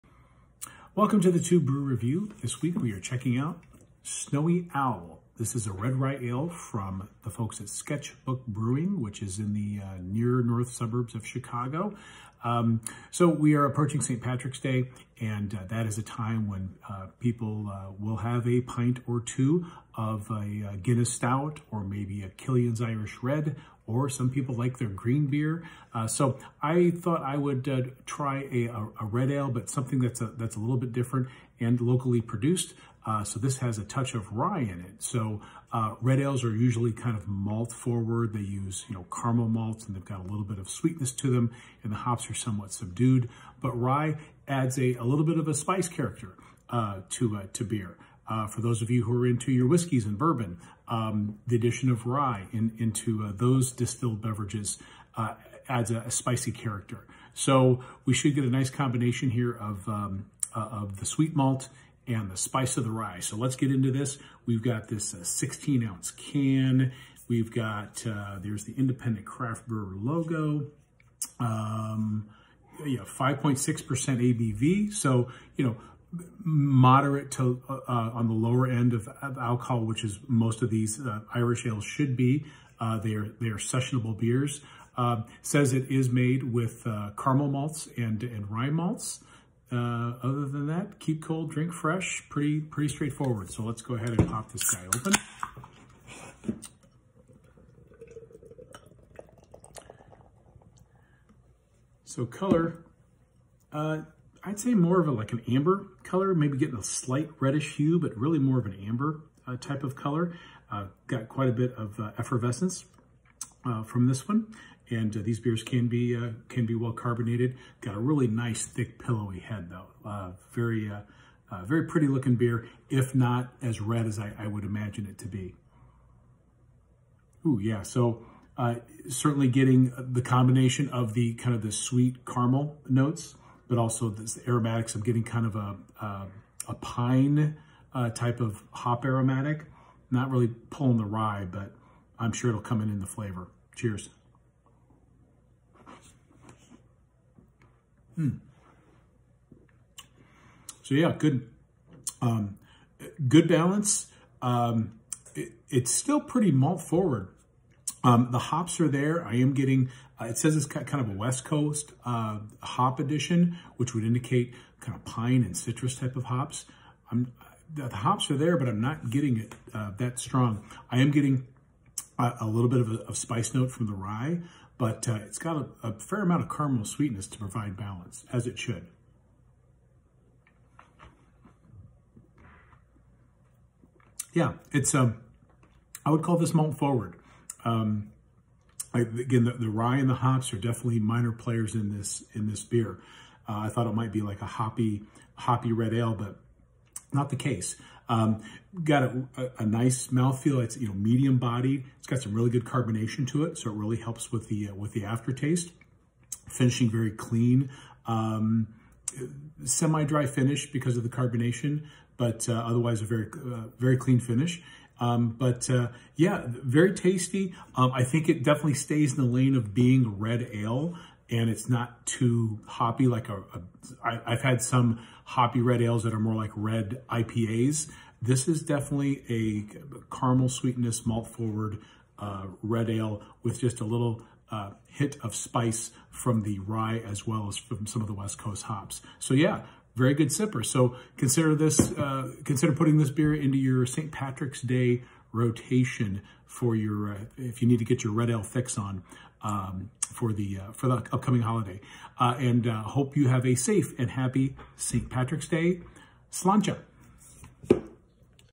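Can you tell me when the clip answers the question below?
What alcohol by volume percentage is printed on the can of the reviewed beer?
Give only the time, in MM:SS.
01:13.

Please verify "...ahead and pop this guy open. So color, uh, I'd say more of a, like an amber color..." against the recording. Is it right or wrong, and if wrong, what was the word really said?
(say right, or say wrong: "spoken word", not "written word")
right.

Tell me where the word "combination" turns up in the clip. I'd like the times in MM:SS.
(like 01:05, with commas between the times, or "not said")
00:58, 02:10.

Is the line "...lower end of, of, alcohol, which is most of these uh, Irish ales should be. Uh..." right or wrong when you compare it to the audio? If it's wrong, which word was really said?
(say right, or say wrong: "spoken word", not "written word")
right.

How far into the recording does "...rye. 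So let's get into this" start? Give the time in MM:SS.
01:02.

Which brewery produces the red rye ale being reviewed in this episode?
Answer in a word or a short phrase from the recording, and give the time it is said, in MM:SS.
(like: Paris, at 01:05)
Sketchbook Brewing, at 00:07.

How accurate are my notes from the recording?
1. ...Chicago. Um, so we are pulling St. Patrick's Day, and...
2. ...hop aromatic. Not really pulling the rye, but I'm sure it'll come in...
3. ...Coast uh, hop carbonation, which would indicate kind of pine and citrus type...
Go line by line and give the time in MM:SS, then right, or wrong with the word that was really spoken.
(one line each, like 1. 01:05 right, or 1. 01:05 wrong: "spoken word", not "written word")
1. 00:11 wrong: "approaching", not "pulling"
2. 02:18 right
3. 02:41 wrong: "addition", not "carbonation".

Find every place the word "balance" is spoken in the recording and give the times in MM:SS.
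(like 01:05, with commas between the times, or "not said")
02:33, 02:57.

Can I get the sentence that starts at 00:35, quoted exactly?
So uh, red ales are usually kind of malt forward.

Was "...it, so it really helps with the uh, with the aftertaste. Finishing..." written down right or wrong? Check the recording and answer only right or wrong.
right.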